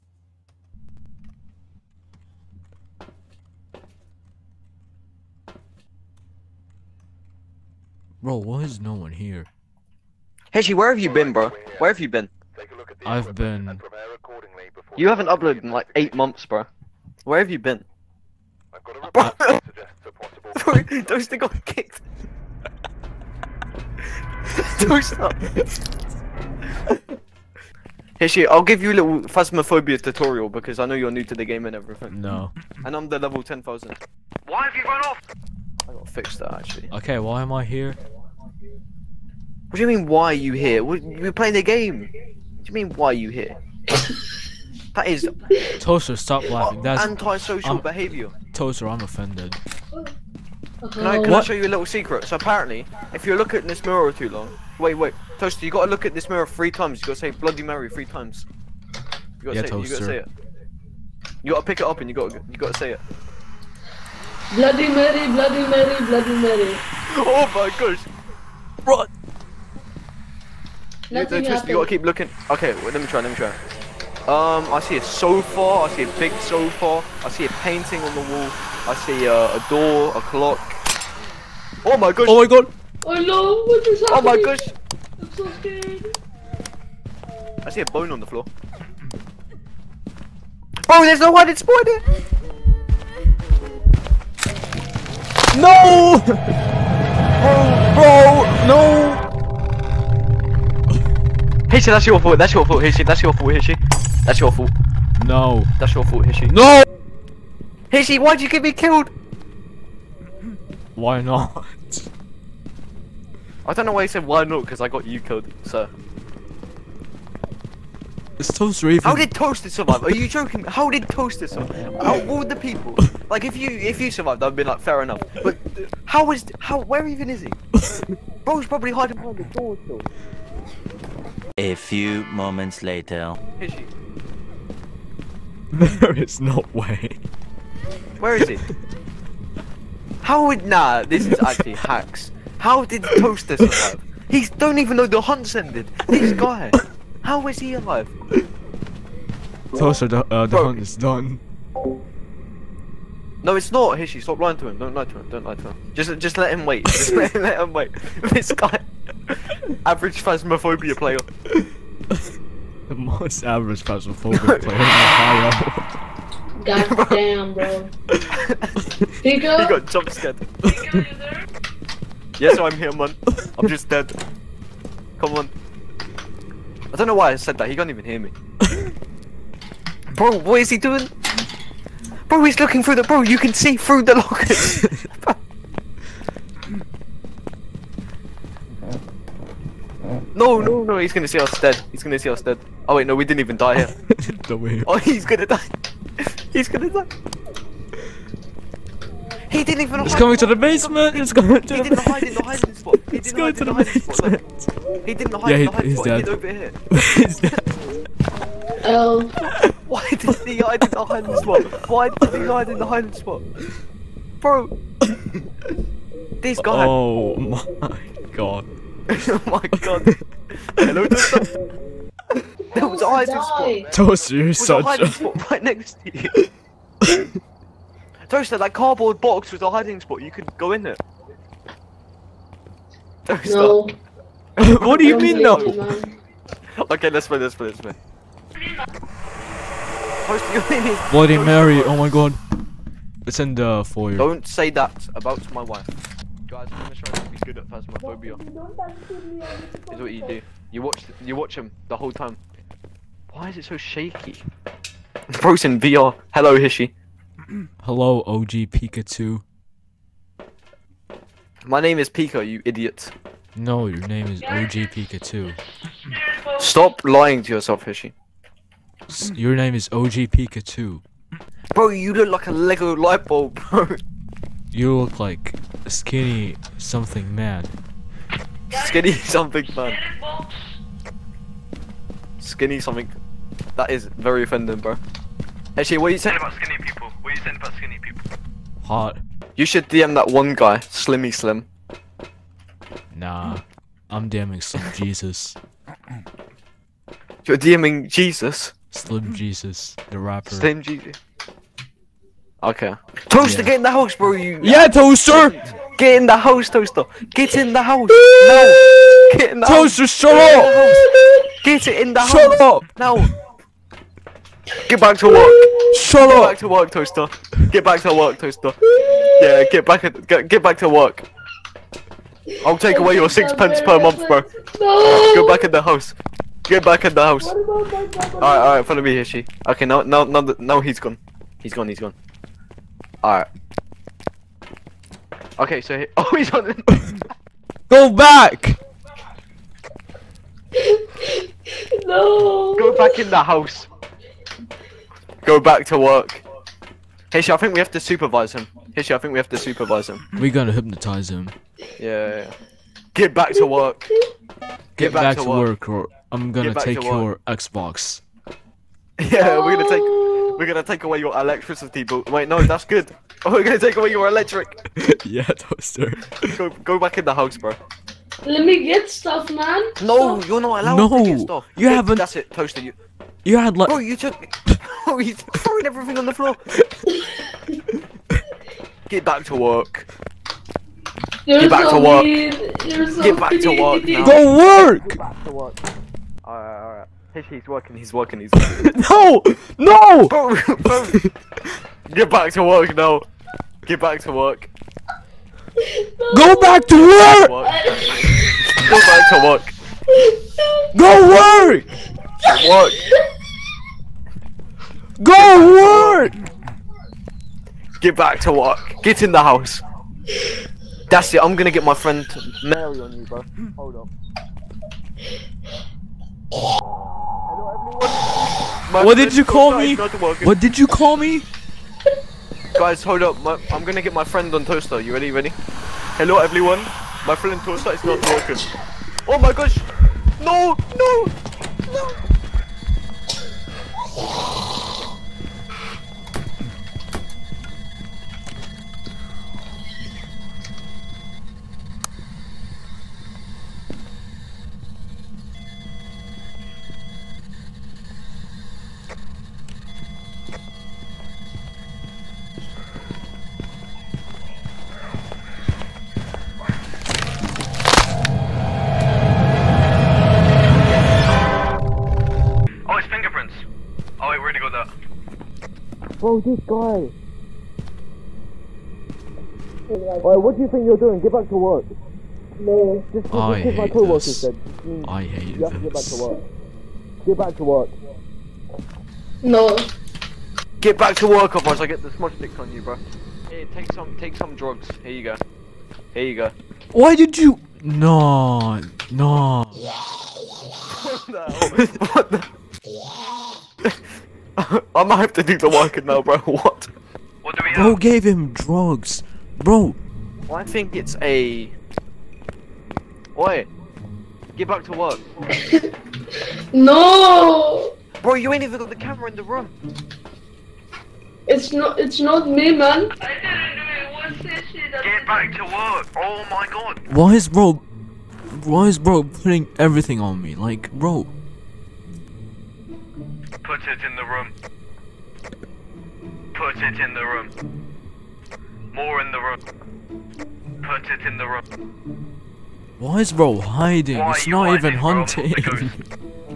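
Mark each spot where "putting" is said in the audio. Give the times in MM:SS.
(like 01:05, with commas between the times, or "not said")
08:39.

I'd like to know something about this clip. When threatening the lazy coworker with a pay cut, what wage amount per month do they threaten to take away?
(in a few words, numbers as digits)
sixpence.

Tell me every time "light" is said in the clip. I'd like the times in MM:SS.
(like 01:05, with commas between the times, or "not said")
04:32.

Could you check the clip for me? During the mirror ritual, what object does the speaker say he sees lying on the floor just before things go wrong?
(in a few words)
a bone.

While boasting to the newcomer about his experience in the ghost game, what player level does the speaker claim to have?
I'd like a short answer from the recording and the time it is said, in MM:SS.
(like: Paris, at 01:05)
10,000, at 00:33.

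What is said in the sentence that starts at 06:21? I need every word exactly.
You're get back so to work.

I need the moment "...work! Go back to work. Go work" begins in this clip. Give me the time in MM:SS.
06:36.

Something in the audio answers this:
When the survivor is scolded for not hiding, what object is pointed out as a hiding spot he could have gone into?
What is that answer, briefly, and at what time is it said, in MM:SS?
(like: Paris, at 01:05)
cardboard box, at 03:48.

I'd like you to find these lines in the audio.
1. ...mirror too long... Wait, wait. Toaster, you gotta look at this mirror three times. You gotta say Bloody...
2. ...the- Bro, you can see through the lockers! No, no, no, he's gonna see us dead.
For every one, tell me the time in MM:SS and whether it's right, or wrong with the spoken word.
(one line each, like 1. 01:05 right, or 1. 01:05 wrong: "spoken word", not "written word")
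1. 00:53 right
2. 03:02 right.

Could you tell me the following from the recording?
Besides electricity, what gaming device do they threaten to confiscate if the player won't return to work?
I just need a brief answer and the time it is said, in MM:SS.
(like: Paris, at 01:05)
Xbox, at 05:57.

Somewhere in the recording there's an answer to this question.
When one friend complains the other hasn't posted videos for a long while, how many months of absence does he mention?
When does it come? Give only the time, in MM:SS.
00:15.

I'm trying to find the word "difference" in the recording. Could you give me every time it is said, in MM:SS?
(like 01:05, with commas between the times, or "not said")
not said.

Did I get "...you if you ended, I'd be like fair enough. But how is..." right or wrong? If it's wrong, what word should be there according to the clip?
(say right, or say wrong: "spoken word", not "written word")
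wrong: "survived", not "ended".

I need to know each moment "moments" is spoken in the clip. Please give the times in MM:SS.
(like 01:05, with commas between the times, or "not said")
02:12.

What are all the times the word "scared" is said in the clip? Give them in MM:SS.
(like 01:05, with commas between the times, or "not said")
01:25, 02:50.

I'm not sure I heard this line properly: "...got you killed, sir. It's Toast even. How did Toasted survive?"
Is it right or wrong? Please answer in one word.
right.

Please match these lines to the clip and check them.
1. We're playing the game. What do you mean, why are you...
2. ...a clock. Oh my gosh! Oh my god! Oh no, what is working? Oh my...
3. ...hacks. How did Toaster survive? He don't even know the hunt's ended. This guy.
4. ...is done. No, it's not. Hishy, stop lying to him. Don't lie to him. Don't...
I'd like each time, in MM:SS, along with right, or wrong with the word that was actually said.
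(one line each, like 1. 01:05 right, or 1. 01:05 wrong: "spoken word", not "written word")
1. 00:40 right
2. 01:20 wrong: "happening", not "working"
3. 02:21 right
4. 02:30 right.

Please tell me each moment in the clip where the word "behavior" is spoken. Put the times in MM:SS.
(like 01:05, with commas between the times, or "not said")
00:47.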